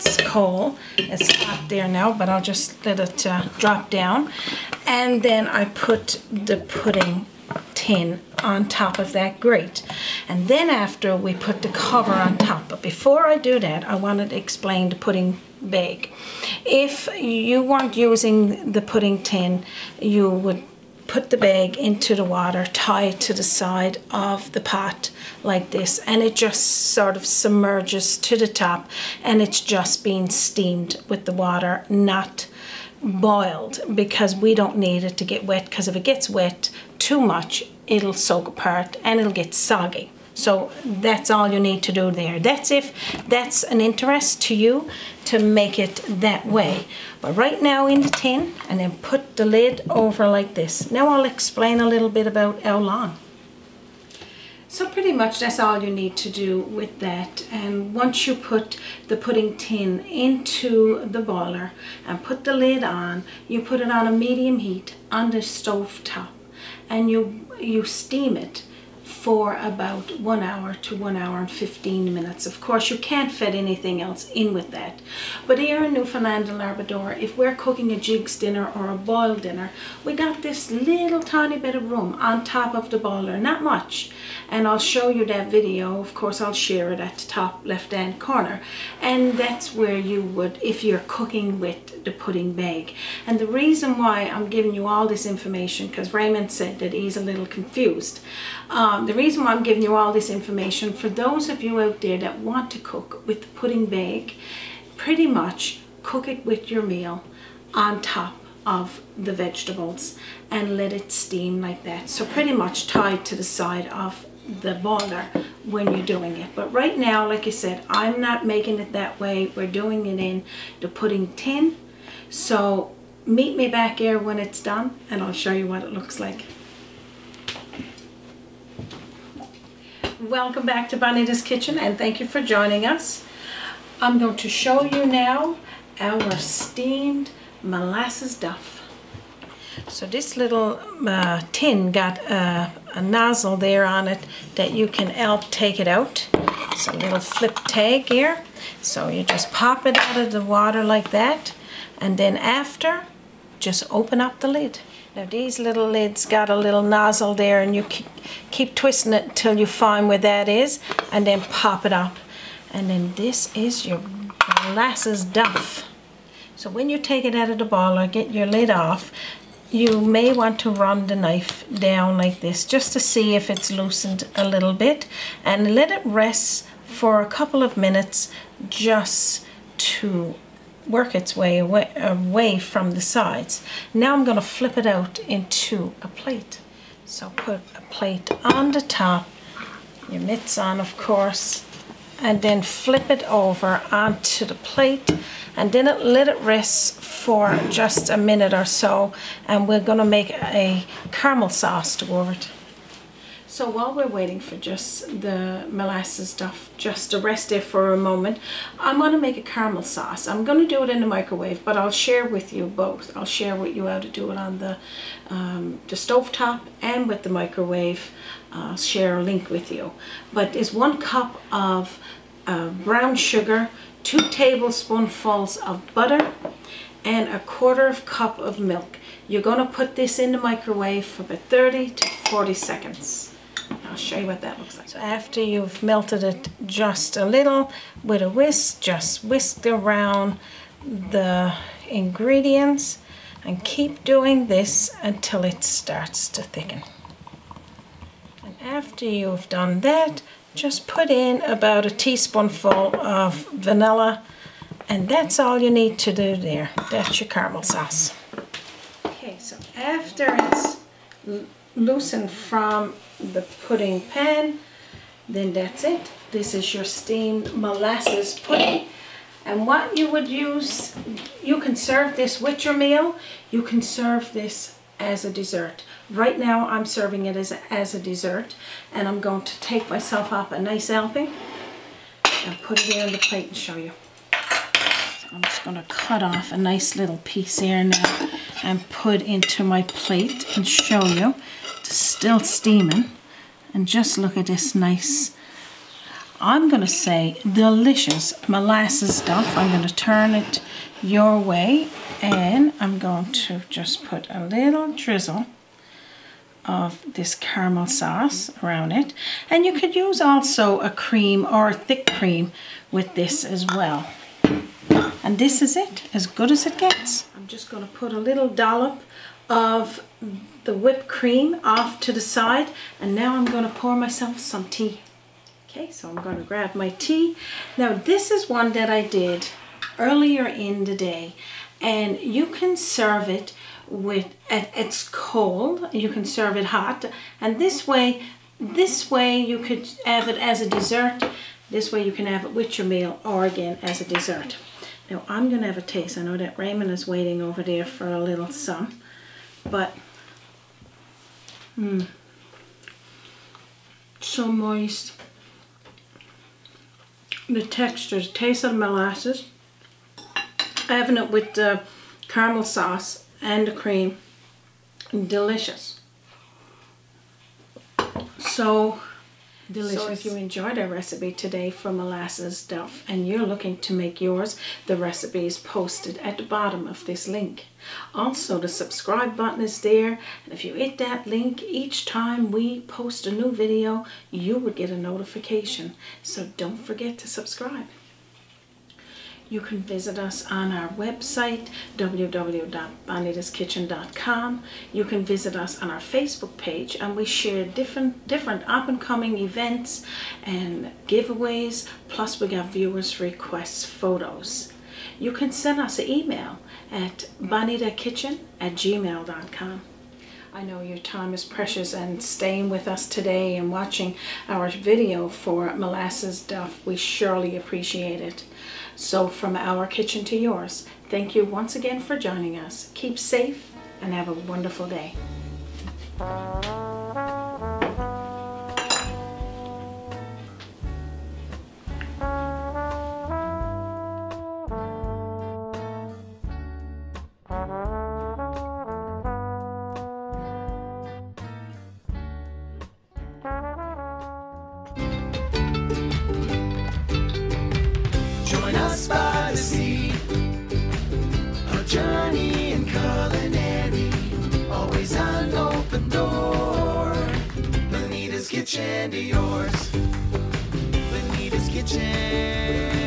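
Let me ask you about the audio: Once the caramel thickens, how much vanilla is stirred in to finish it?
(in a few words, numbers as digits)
1 teaspoon.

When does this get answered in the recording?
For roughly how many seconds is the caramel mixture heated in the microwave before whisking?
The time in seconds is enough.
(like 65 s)
231 s.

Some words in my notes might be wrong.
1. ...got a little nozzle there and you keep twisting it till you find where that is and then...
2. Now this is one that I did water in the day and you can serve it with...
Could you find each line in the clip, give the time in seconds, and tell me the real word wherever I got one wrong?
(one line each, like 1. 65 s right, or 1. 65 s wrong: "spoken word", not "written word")
1. 156 s right
2. 327 s wrong: "earlier", not "water".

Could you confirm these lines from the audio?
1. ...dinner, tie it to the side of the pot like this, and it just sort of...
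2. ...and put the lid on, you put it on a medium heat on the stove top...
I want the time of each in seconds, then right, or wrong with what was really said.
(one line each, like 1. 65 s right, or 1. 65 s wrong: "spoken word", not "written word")
1. 22 s wrong: "water", not "dinner"
2. 62 s right.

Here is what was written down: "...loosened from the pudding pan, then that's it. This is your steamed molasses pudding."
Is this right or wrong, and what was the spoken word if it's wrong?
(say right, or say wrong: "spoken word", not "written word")
right.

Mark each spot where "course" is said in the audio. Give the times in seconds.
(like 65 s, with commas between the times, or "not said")
72 s, 86 s, 190 s.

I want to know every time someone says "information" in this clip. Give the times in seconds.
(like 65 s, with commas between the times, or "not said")
95 s, 100 s.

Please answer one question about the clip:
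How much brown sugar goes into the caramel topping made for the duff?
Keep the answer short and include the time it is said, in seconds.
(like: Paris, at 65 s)
1 cup, at 220 s.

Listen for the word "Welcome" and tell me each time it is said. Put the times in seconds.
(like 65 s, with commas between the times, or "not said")
130 s.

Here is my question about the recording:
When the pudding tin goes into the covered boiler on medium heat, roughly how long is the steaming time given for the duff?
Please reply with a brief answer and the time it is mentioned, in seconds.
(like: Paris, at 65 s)
1 hour to 1 hour 15 minutes, at 70 s.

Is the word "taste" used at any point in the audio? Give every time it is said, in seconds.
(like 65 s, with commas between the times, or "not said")
345 s, 358 s.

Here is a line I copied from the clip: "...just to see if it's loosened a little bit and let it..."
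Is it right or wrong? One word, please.
right.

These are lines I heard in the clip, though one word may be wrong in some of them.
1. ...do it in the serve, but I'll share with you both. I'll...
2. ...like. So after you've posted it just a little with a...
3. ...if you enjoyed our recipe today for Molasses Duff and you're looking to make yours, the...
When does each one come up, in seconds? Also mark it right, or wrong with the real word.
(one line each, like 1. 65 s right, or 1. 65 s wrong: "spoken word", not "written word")
1. 210 s wrong: "microwave", not "serve"
2. 234 s wrong: "melted", not "posted"
3. 370 s right.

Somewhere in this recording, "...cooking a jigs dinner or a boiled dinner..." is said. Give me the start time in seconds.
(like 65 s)
77 s.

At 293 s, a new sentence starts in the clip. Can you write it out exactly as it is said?
And just look at this nice, I'm gonna say delicious molasses duff.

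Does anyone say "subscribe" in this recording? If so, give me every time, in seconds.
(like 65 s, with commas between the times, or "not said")
378 s, 387 s.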